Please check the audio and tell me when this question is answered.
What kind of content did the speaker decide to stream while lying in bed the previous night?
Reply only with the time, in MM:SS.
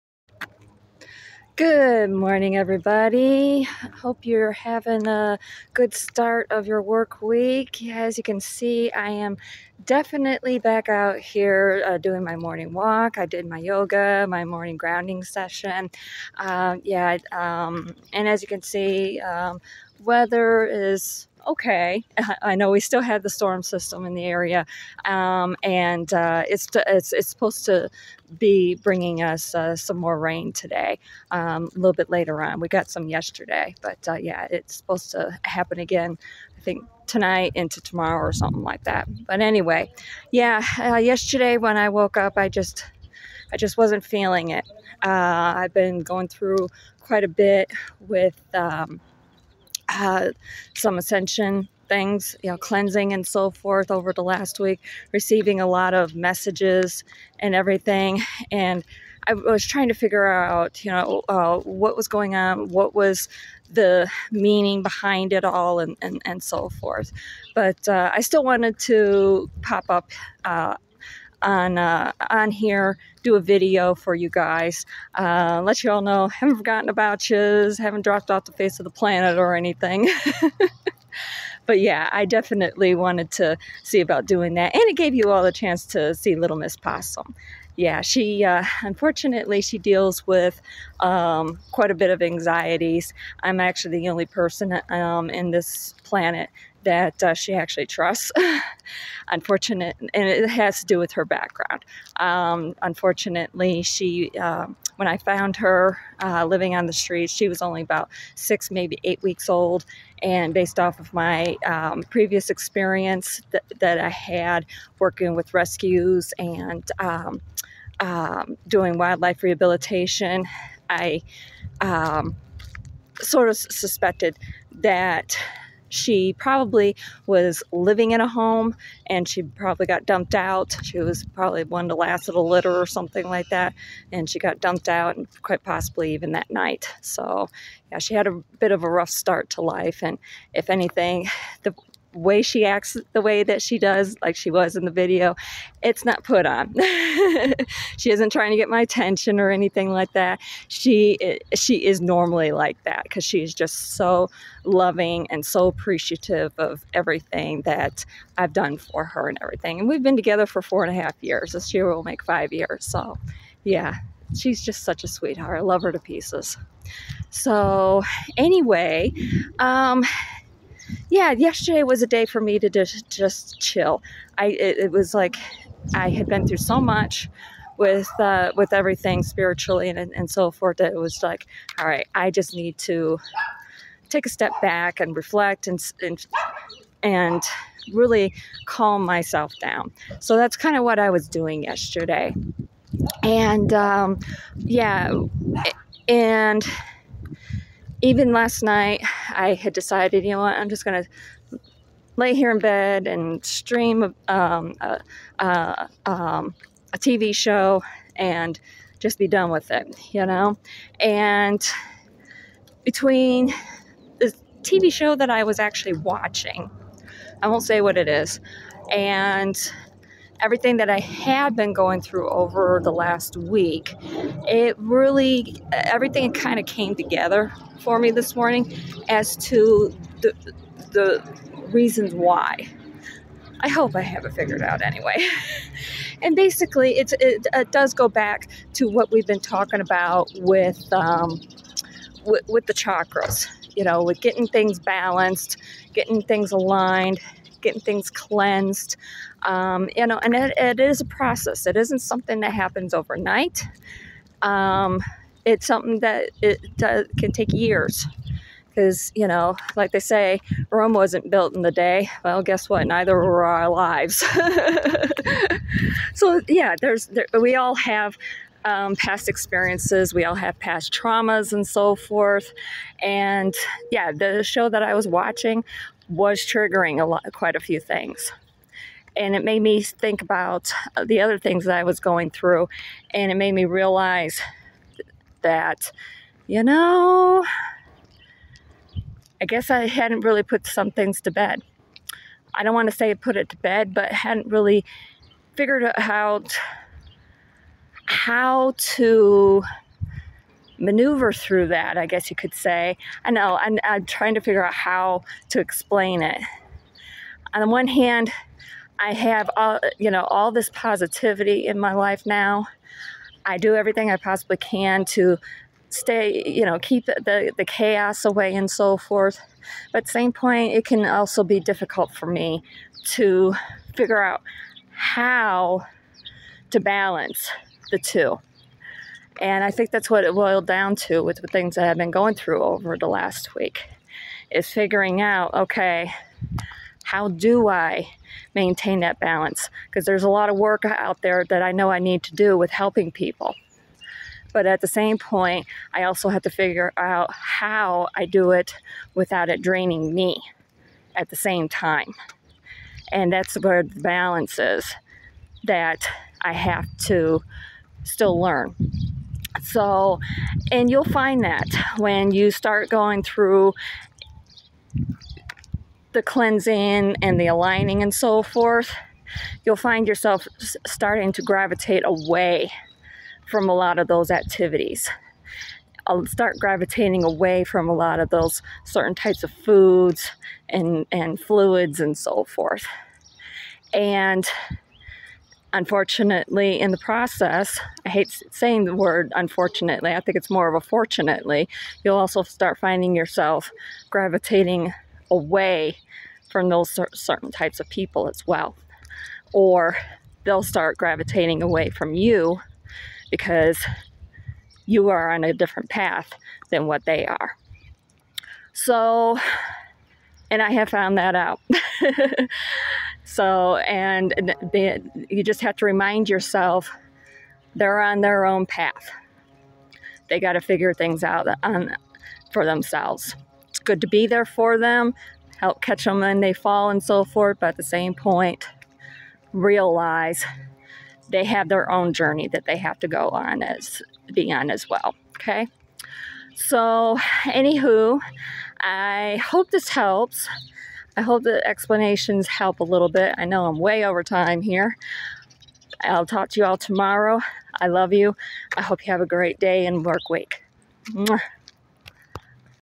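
03:26.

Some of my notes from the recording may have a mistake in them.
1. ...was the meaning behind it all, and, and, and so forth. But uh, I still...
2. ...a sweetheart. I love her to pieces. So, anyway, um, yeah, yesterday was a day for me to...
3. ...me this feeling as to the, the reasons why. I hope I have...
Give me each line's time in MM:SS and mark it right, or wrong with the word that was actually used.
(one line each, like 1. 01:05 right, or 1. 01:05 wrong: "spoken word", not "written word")
1. 01:02 right
2. 02:45 right
3. 03:47 wrong: "morning", not "feeling".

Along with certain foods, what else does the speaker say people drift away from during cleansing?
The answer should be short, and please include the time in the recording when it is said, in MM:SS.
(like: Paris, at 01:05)
fluids, at 06:21.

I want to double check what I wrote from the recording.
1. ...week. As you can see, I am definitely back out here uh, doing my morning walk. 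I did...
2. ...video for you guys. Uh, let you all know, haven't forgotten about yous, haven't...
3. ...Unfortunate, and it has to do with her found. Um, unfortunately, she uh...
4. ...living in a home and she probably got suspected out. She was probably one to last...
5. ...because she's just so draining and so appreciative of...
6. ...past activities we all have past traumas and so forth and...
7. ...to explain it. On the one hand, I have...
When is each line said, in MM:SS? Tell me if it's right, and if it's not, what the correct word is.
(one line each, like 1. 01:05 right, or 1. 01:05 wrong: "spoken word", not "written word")
1. 00:07 right
2. 01:13 right
3. 01:39 wrong: "background", not "found"
4. 02:07 wrong: "dumped", not "suspected"
5. 02:33 wrong: "loving", not "draining"
6. 04:28 wrong: "experiences", not "activities"
7. 05:05 right.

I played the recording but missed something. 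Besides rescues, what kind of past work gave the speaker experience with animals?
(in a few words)
wildlife rehabilitation.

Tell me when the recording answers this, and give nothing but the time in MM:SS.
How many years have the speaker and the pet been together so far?
02:40.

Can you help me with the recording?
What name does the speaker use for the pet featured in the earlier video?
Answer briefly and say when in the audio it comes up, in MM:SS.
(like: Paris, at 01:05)
Little Miss Possum, at 01:26.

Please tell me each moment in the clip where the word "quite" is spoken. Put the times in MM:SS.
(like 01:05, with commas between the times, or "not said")
00:46, 01:31, 02:15, 04:37.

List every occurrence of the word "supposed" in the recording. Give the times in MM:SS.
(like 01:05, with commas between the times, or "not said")
00:27, 00:34.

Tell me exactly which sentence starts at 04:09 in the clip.
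Um, you know, and it, it is a process.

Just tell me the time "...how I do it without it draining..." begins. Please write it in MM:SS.
05:47.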